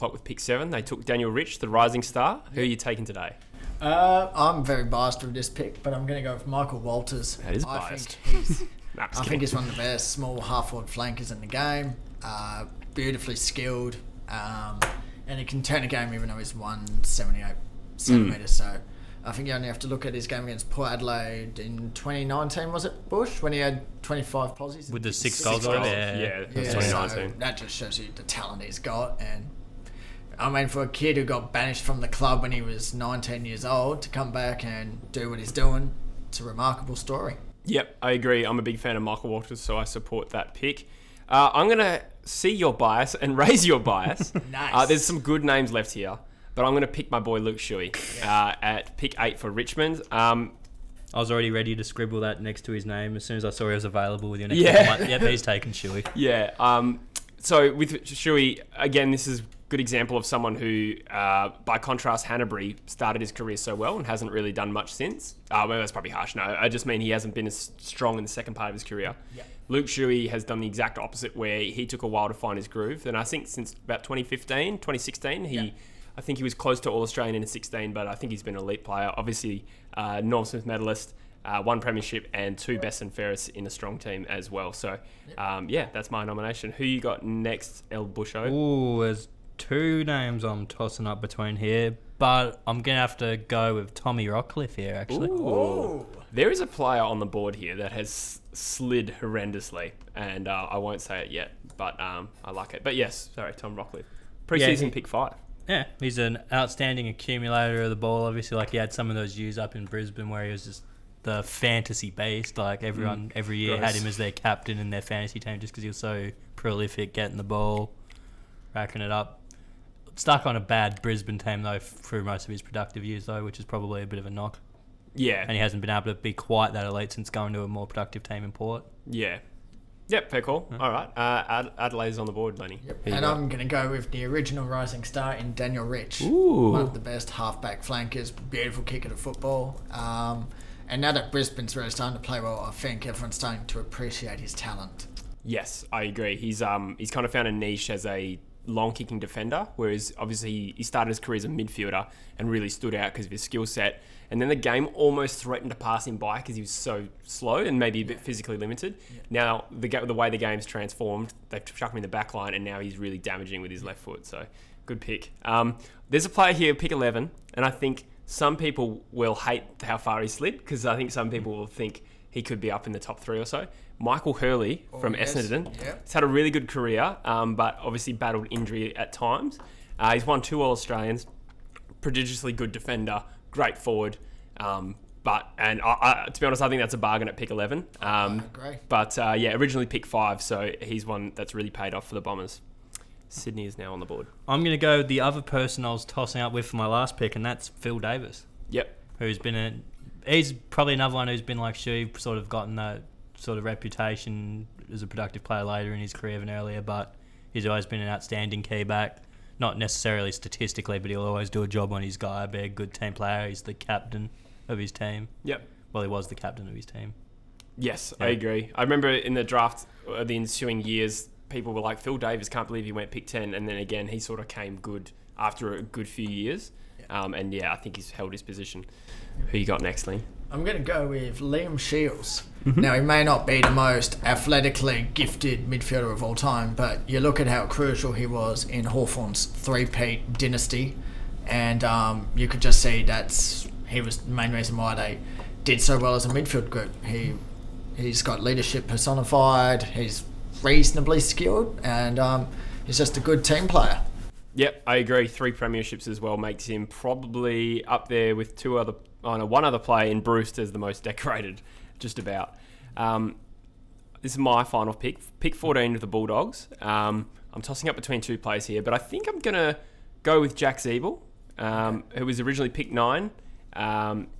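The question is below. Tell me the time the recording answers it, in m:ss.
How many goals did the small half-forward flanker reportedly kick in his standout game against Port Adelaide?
0:25.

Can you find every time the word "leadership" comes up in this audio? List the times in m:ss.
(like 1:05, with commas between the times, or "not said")
4:08.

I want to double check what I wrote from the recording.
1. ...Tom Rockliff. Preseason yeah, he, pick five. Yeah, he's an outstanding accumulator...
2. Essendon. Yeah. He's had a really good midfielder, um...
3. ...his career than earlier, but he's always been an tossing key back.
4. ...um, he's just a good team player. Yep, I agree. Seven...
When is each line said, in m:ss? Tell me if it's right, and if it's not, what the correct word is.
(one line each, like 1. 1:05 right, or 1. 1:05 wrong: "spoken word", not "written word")
1. 1:43 right
2. 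2:55 wrong: "career", not "midfielder"
3. 3:25 wrong: "outstanding", not "tossing"
4. 4:12 wrong: "Three", not "Seven".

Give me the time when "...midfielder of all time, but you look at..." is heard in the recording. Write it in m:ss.
3:55.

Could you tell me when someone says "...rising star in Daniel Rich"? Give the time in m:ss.
2:14.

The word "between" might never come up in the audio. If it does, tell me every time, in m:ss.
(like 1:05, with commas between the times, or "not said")
1:31, 4:27.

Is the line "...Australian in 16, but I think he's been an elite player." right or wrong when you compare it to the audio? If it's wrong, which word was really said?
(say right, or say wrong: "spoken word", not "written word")
right.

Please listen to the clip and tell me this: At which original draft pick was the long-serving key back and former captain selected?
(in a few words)
10.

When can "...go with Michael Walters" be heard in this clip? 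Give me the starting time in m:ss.
0:06.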